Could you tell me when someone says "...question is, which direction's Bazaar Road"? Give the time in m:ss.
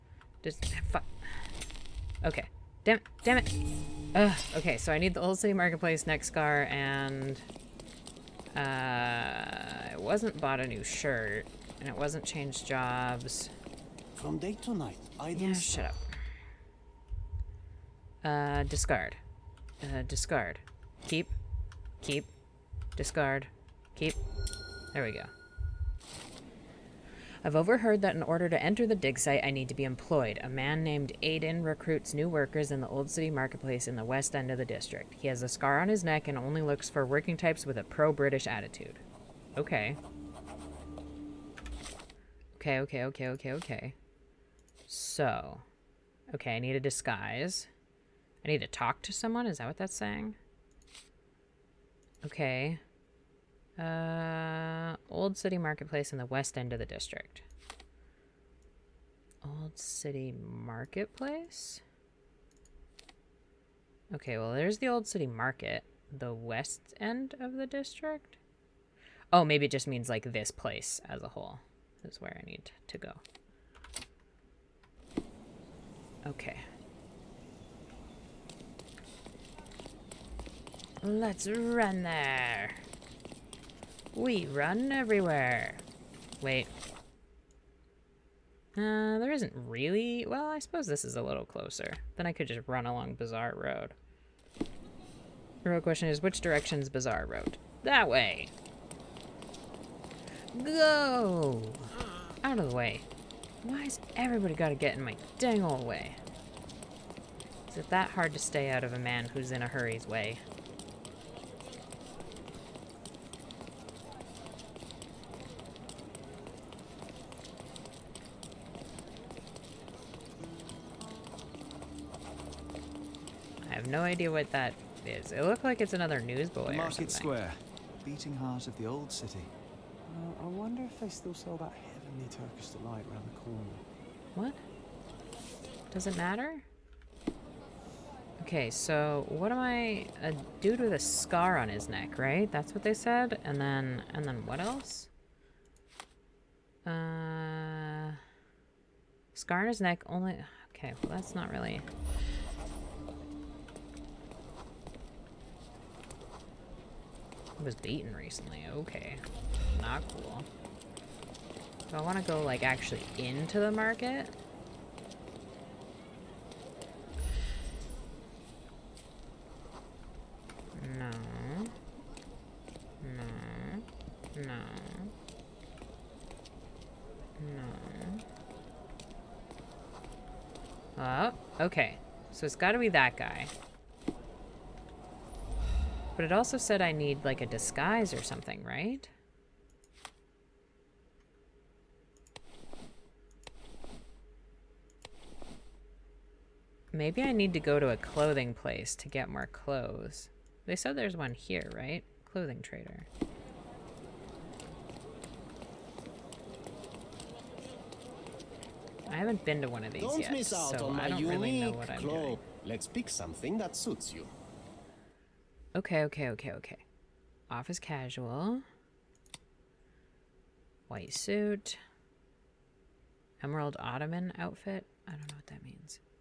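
1:35.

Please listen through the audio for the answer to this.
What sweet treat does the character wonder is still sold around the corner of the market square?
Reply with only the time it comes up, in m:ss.
2:12.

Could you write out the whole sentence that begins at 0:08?
Uh, I wasn't bought a new shirt, and it wasn't changed jobs.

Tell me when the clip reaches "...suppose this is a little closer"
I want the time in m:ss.
1:30.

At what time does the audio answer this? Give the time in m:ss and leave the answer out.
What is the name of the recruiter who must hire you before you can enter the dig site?
0:31.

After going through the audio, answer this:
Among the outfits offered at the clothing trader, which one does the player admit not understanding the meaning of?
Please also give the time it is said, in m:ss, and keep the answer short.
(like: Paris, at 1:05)
Emerald Ottoman outfit, at 3:43.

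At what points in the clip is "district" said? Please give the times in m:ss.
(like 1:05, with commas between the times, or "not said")
0:34, 0:56, 1:07.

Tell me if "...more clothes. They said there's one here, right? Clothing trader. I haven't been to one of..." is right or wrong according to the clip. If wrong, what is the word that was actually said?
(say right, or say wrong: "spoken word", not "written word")
right.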